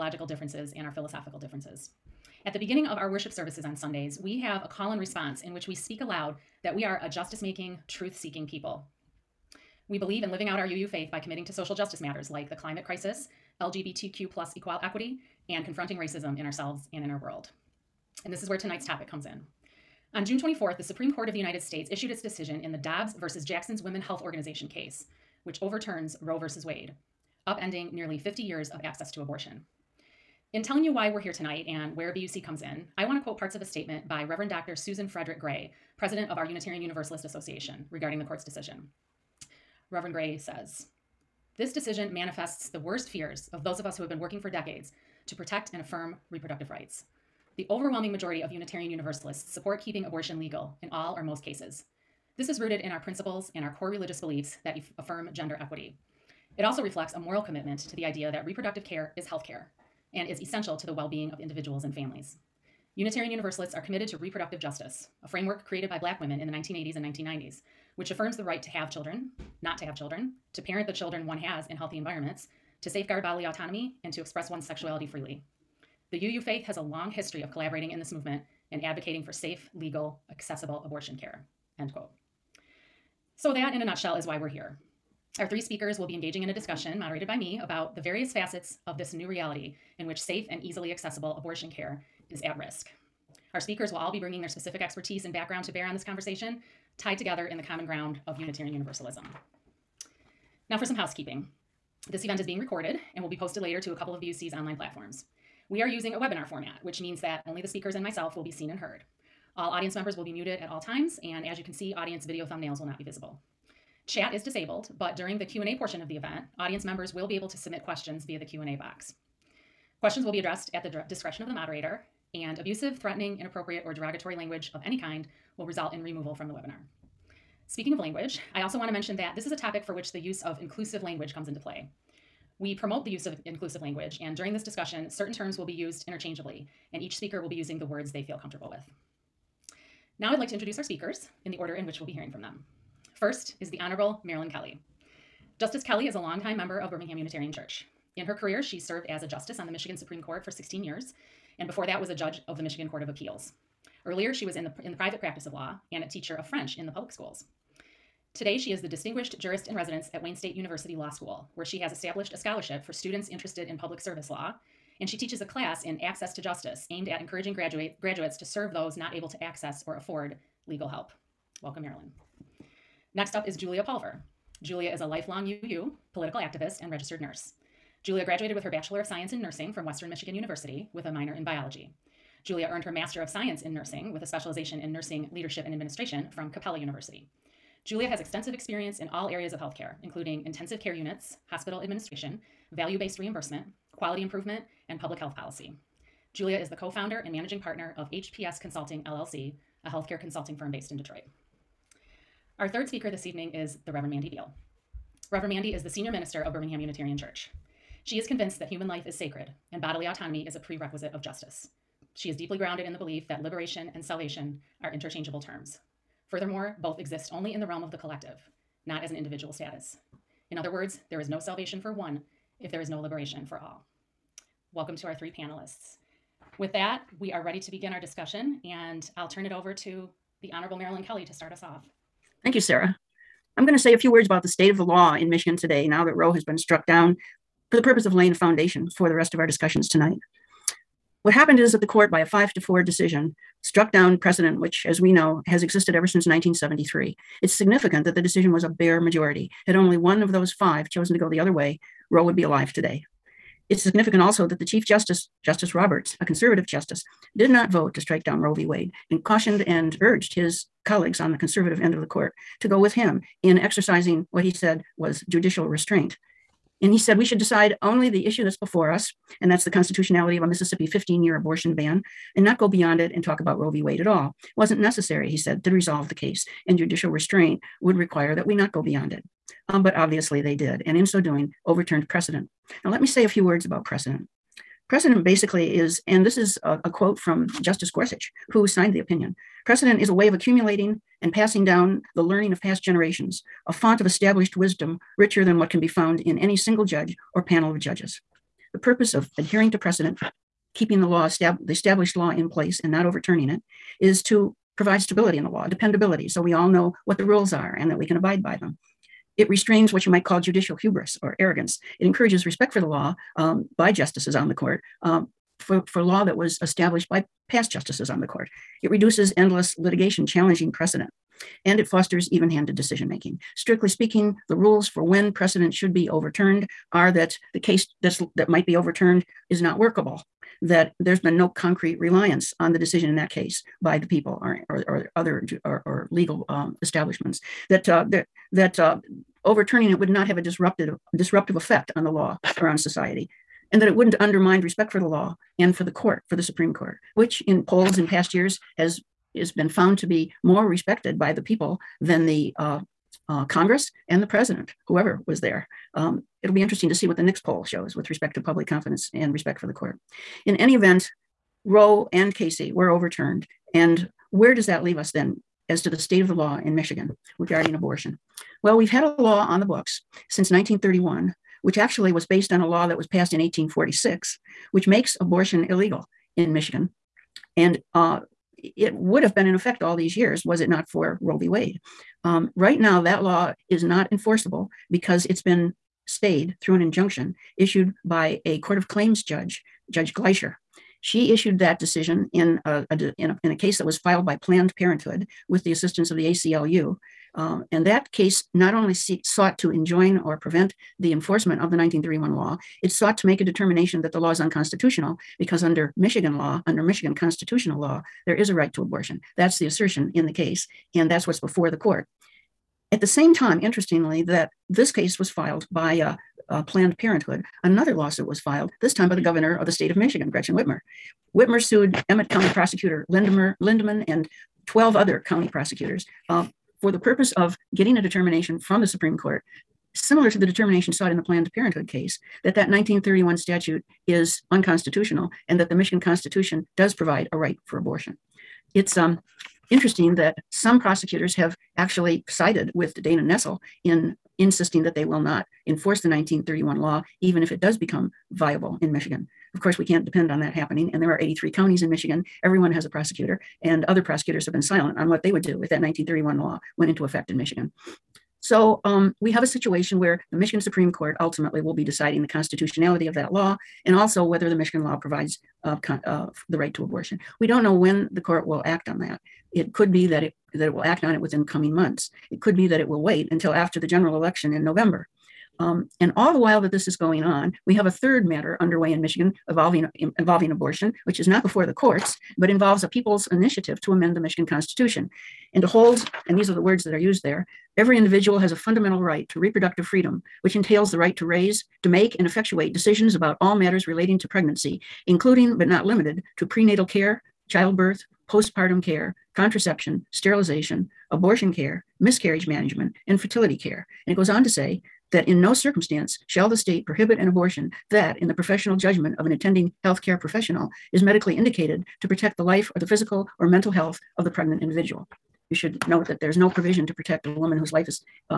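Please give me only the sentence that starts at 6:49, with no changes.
That's the assertion in the case, and that's what's before the court.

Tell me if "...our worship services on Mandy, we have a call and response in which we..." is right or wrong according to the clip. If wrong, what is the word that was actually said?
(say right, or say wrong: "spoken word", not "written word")
wrong: "Sundays", not "Mandy".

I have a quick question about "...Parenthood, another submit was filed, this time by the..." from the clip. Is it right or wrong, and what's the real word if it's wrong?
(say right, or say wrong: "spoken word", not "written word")
wrong: "lawsuit", not "submit".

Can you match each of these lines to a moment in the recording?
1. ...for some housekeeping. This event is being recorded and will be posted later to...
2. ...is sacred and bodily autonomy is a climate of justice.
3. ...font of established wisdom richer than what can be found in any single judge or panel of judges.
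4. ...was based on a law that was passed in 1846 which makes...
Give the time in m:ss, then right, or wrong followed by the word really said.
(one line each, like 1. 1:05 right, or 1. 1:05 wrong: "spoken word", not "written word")
1. 1:40 right
2. 3:29 wrong: "prerequisite", not "climate"
3. 4:53 right
4. 6:12 right.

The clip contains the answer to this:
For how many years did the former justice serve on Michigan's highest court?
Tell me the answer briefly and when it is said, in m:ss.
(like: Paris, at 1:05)
16, at 2:30.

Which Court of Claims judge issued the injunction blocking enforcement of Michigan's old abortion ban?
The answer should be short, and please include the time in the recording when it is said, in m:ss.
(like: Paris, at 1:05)
Judge Gleicher, at 6:29.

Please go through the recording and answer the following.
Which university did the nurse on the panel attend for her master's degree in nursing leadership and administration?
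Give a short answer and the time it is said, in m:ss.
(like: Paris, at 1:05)
Capella University, at 3:06.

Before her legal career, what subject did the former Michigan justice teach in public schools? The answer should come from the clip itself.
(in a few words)
French.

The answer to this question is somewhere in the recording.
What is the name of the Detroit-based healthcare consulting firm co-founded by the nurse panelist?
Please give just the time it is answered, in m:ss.
3:18.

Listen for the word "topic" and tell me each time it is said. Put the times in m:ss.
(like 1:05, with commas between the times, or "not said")
0:18, 2:09.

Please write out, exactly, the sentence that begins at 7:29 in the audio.
Of course, we can't depend on that happening.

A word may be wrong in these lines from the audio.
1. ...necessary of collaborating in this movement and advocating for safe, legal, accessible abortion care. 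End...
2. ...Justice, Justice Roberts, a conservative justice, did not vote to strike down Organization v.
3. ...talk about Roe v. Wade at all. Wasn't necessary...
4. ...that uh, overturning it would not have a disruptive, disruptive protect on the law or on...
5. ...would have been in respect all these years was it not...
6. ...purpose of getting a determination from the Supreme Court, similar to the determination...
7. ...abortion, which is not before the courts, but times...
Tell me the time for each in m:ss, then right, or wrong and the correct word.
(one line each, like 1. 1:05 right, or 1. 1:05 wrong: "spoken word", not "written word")
1. 1:17 wrong: "history", not "necessary"
2. 4:14 wrong: "Roe", not "Organization"
3. 4:33 right
4. 5:38 wrong: "effect", not "protect"
5. 6:18 wrong: "effect", not "respect"
6. 7:06 right
7. 8:00 wrong: "involves", not "times".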